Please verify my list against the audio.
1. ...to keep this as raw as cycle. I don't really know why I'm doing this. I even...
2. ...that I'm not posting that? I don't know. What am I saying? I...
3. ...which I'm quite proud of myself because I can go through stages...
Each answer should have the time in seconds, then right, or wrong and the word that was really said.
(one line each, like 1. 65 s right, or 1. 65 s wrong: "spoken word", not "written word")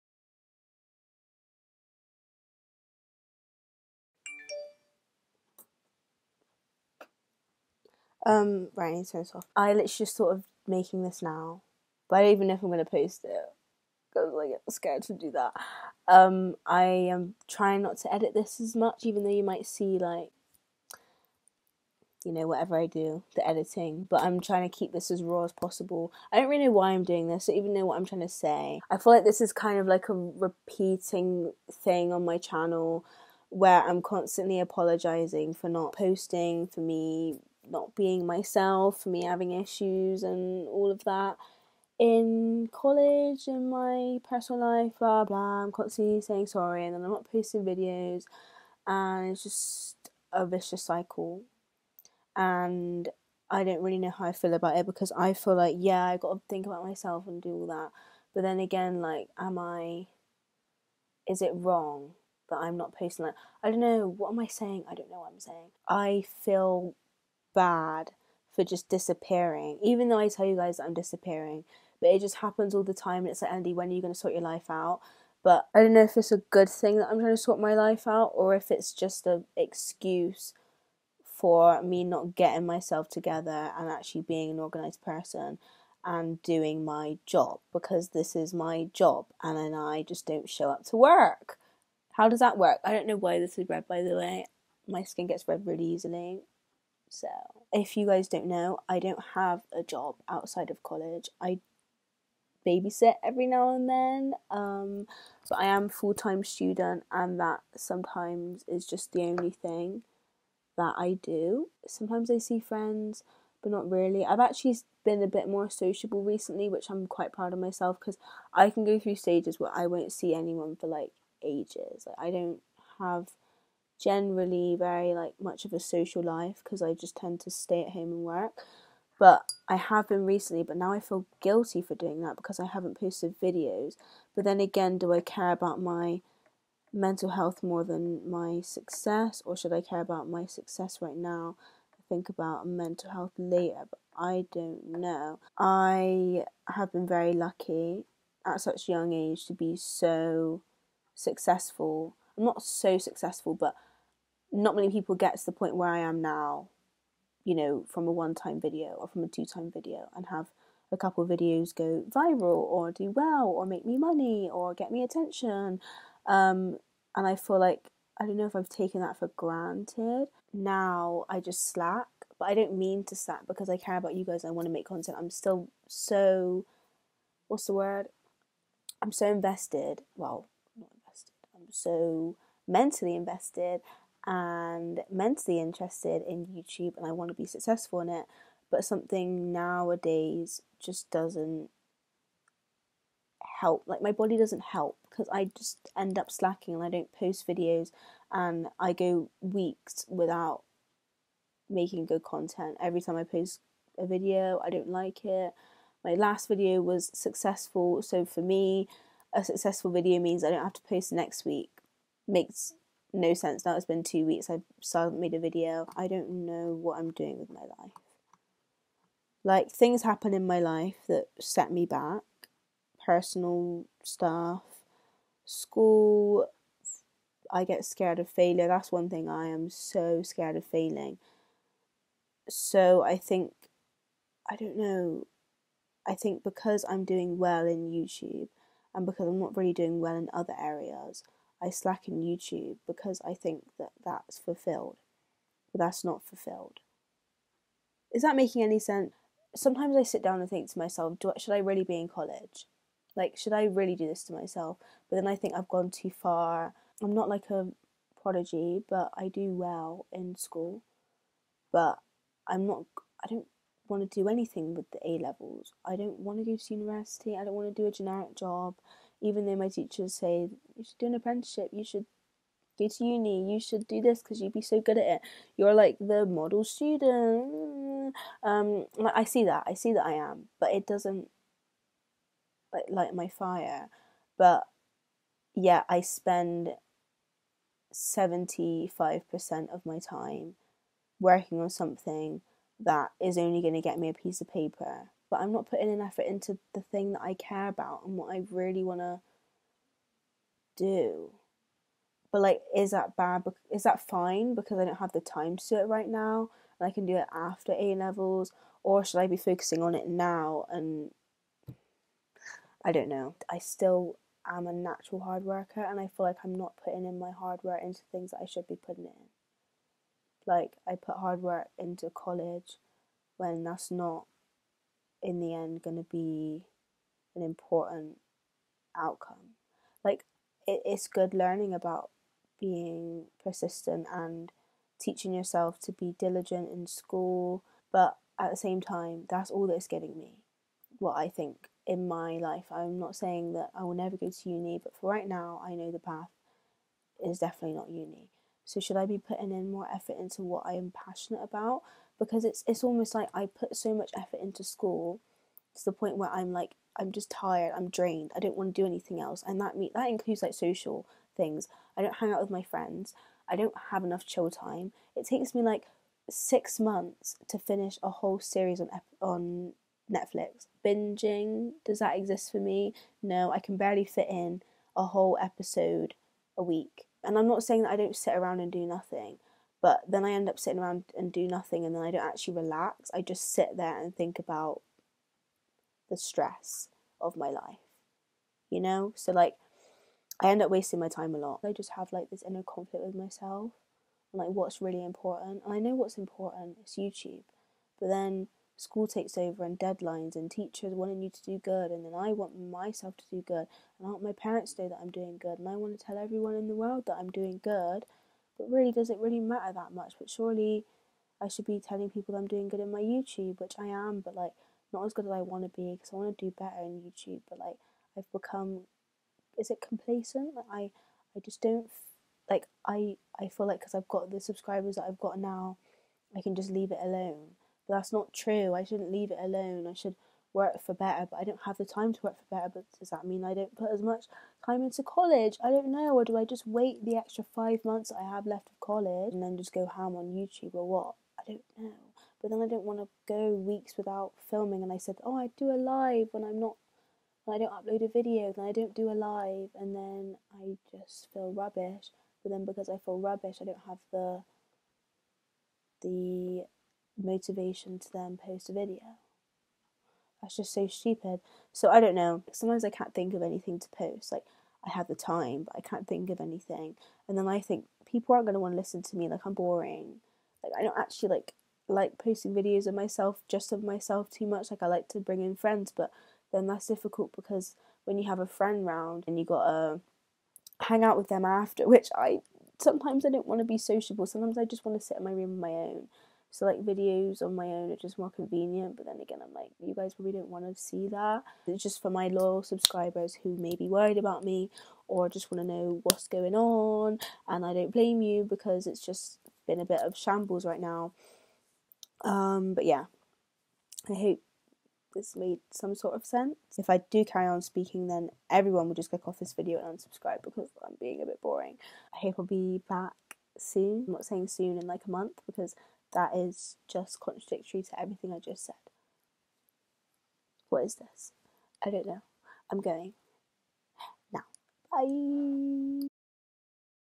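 1. 24 s wrong: "possible", not "cycle"
2. 62 s right
3. 116 s right.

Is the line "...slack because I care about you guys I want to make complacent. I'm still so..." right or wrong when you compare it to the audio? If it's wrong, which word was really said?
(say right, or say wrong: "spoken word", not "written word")
wrong: "content", not "complacent".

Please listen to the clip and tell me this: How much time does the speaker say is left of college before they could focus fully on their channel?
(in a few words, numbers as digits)
5 months.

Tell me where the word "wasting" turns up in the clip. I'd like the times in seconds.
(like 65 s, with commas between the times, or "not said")
390 s.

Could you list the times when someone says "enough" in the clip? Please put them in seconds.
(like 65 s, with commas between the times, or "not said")
364 s.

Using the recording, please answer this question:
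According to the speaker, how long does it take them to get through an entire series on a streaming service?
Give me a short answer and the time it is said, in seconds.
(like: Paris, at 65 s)
6 months, at 366 s.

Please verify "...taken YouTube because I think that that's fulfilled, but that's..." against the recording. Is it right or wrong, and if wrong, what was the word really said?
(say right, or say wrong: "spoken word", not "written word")
wrong: "slacken", not "taken".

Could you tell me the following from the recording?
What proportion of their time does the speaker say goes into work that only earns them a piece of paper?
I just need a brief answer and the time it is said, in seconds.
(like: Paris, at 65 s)
75%, at 287 s.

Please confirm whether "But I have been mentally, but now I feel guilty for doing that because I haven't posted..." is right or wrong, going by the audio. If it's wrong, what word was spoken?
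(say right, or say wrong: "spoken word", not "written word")
wrong: "recently", not "mentally".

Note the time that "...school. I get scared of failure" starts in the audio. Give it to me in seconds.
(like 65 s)
225 s.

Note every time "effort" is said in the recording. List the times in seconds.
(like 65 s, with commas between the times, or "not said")
296 s, 349 s, 354 s.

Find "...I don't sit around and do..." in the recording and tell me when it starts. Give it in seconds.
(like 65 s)
377 s.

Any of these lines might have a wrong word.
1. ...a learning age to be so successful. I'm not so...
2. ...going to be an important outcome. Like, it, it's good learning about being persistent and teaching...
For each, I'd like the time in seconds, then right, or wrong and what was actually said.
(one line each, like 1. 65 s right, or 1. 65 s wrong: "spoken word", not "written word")
1. 148 s wrong: "young", not "learning"
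2. 325 s right.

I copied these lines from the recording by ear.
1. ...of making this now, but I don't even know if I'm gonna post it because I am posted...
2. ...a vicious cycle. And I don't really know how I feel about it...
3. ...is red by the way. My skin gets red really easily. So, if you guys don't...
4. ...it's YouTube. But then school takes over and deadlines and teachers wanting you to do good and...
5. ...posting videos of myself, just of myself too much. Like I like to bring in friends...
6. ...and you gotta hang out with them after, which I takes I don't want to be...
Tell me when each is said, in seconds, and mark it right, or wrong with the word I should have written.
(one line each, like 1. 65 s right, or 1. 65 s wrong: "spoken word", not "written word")
1. 10 s wrong: "scared", not "posted"
2. 50 s right
3. 93 s right
4. 396 s right
5. 472 s right
6. 479 s wrong: "sometimes", not "takes".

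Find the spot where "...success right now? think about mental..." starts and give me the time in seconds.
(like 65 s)
140 s.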